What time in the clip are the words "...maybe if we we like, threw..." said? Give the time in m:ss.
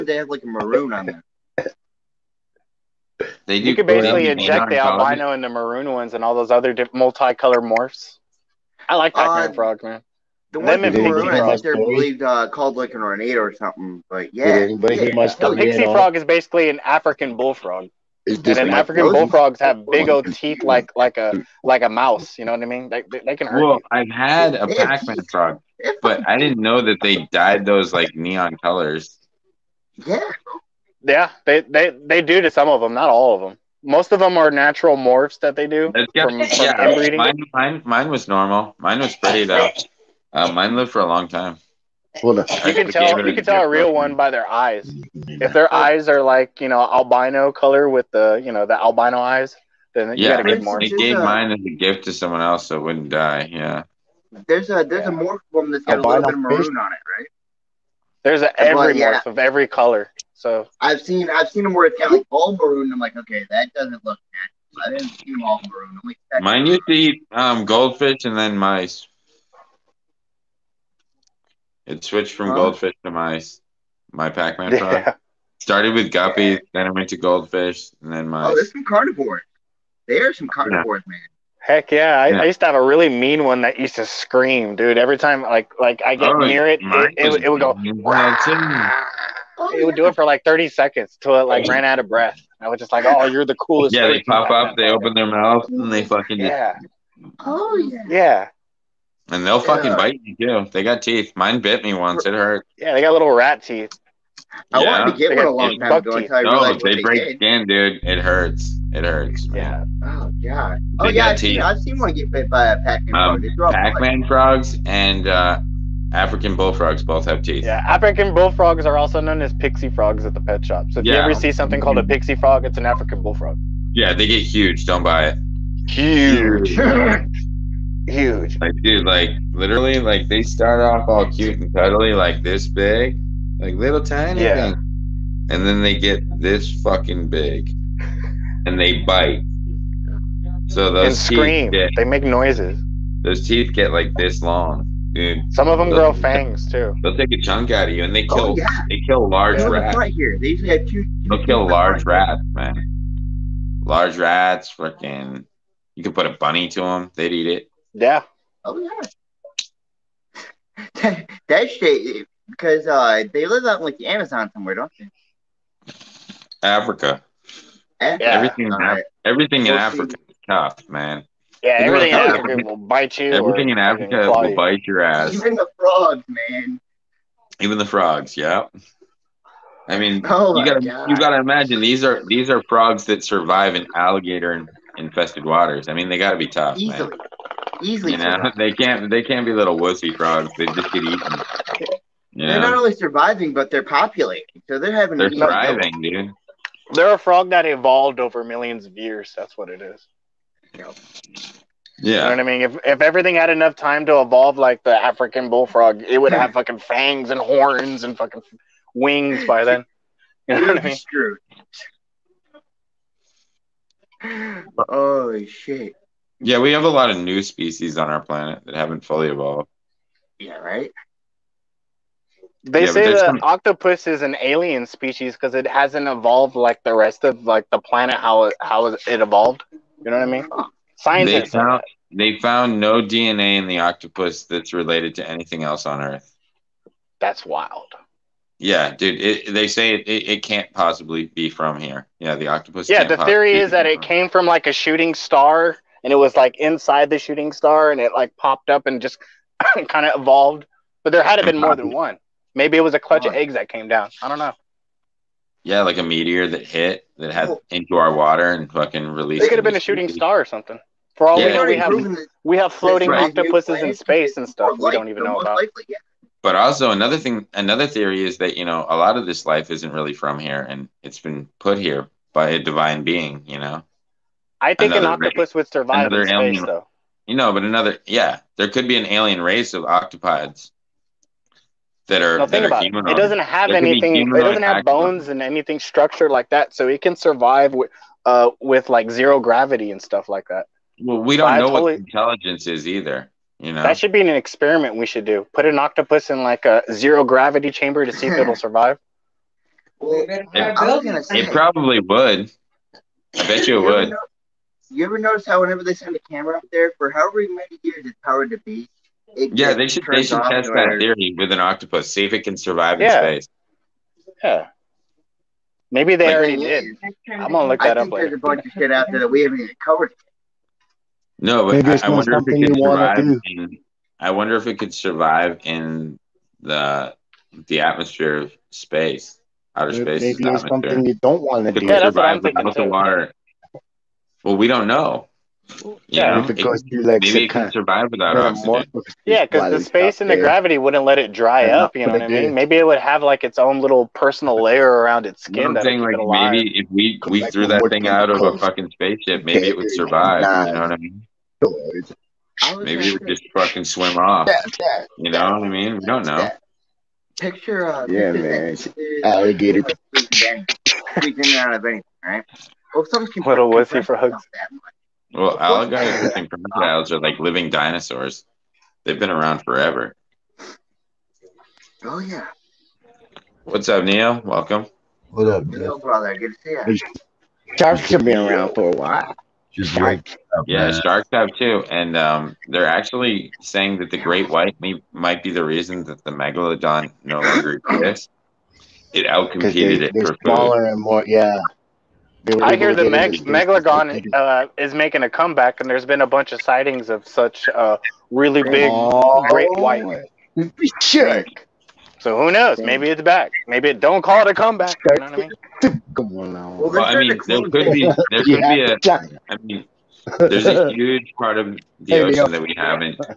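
5:46.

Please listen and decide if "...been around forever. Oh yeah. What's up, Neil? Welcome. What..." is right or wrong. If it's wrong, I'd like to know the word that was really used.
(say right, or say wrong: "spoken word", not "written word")
right.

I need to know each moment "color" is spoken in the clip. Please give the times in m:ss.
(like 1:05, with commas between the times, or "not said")
0:06, 0:28, 0:47, 0:59.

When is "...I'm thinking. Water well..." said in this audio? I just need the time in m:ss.
5:32.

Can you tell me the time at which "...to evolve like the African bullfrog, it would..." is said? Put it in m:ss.
3:24.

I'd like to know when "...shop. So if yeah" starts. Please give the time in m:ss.
2:00.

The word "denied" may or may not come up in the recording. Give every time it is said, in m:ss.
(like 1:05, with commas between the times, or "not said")
not said.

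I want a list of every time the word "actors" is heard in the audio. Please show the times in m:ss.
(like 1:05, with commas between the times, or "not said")
not said.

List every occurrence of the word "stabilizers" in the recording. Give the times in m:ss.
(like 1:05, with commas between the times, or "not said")
not said.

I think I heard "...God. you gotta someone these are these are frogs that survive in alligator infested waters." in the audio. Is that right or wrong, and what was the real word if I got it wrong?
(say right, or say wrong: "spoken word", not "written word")
wrong: "imagine", not "someone".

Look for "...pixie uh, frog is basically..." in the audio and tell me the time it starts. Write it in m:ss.
0:15.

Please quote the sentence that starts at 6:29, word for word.
It outcompeted they, it for smaller food.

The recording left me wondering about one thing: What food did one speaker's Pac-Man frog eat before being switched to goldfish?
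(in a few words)
Guppy.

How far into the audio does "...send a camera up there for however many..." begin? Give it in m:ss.
5:05.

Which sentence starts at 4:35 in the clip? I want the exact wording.
would survive another in alien, space, though.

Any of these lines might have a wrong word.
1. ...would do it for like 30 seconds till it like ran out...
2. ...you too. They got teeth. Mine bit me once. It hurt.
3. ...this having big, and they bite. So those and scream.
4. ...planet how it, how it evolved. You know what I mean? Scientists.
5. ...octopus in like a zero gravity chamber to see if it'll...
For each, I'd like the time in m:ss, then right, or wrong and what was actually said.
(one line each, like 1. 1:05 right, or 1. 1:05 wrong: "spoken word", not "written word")
1. 1:29 right
2. 1:40 right
3. 2:16 wrong: "fucking", not "having"
4. 3:47 right
5. 4:55 right.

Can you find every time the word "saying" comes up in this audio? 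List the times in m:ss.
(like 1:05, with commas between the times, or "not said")
6:23.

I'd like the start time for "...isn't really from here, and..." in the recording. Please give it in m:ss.
4:29.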